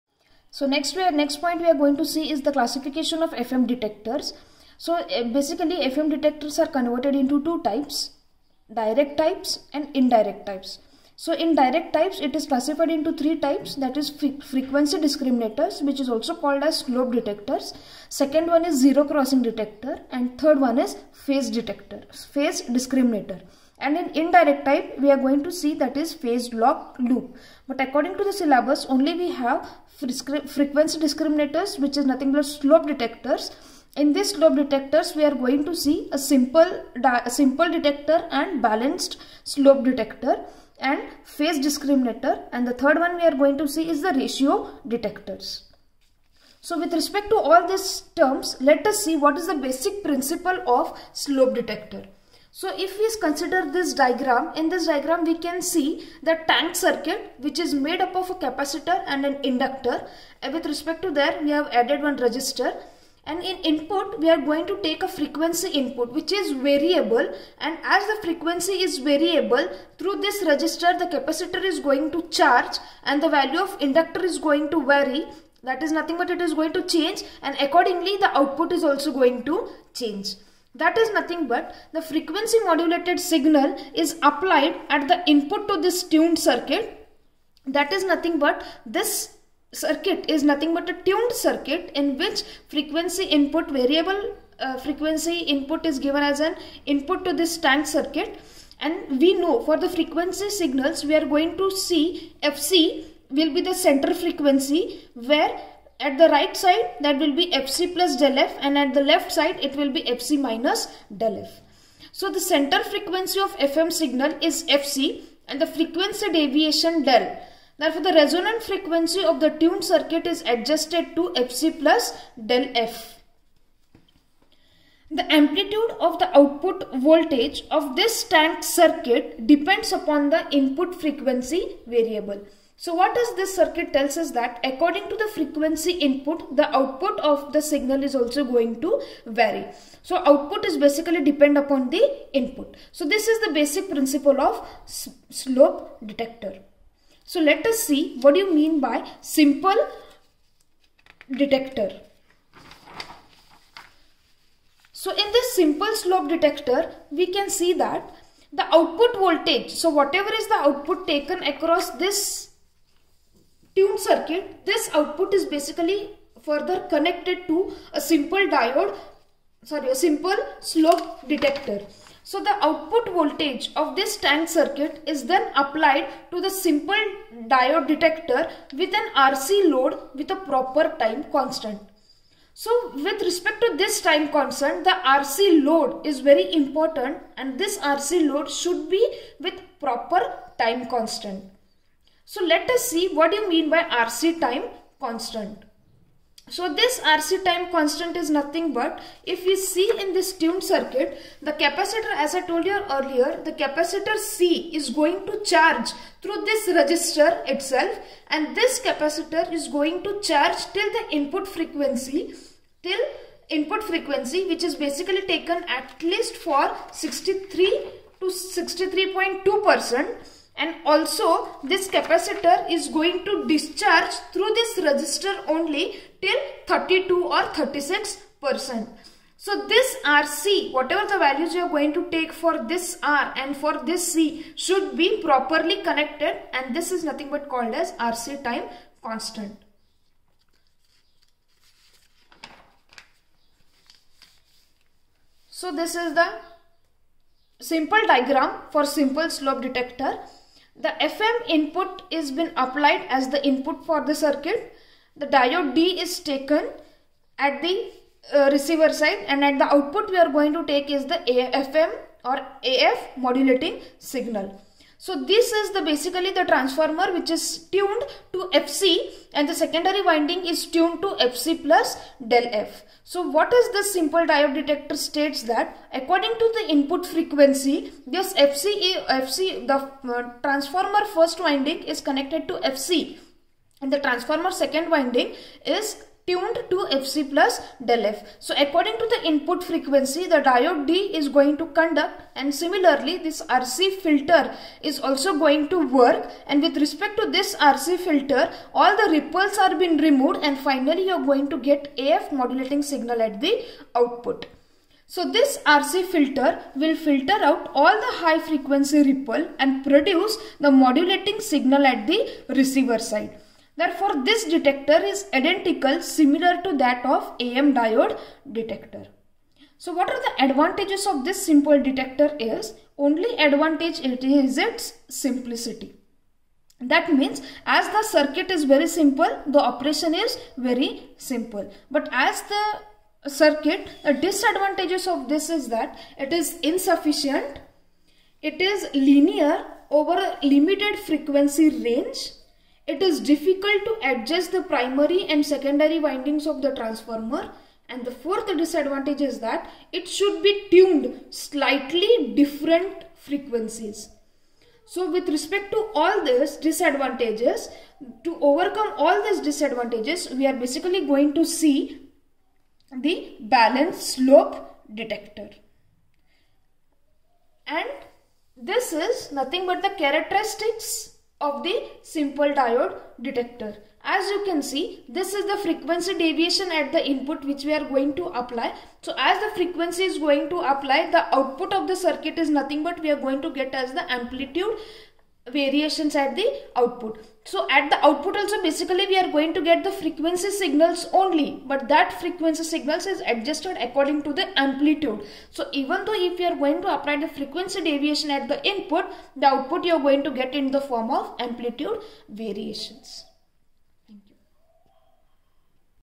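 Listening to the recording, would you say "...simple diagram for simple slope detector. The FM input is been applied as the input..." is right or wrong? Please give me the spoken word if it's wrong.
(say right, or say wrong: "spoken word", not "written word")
right.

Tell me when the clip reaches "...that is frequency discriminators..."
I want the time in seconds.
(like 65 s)
13 s.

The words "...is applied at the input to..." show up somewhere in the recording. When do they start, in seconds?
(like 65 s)
83 s.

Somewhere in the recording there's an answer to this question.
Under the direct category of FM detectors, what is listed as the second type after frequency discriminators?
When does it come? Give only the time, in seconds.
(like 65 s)
18 s.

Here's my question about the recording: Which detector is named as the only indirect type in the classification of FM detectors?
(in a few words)
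Phase lock loop.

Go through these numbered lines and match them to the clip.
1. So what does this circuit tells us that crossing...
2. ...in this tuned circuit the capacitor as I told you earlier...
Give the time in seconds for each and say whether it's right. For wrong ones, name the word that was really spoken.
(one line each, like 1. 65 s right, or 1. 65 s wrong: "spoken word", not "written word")
1. 132 s wrong: "according", not "crossing"
2. 200 s right.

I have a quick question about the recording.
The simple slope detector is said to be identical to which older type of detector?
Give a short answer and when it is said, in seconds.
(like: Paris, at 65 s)
AM diode detector, at 317 s.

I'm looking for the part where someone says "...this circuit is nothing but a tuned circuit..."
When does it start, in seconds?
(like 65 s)
88 s.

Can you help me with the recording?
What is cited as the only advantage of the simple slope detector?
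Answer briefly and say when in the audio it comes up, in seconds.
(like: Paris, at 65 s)
Its simplicity, at 324 s.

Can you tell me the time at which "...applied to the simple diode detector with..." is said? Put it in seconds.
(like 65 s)
175 s.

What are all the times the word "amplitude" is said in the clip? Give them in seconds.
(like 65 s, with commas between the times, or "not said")
125 s, 384 s, 394 s, 401 s.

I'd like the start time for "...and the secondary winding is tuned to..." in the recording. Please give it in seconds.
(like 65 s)
269 s.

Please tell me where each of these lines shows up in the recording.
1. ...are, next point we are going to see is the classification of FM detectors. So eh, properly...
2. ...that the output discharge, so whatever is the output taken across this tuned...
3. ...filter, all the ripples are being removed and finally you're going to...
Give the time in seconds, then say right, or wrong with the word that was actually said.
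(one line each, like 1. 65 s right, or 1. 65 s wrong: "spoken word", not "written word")
1. 1 s wrong: "basically", not "properly"
2. 157 s wrong: "voltage", not "discharge"
3. 297 s right.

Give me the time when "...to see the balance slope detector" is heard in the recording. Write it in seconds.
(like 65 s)
361 s.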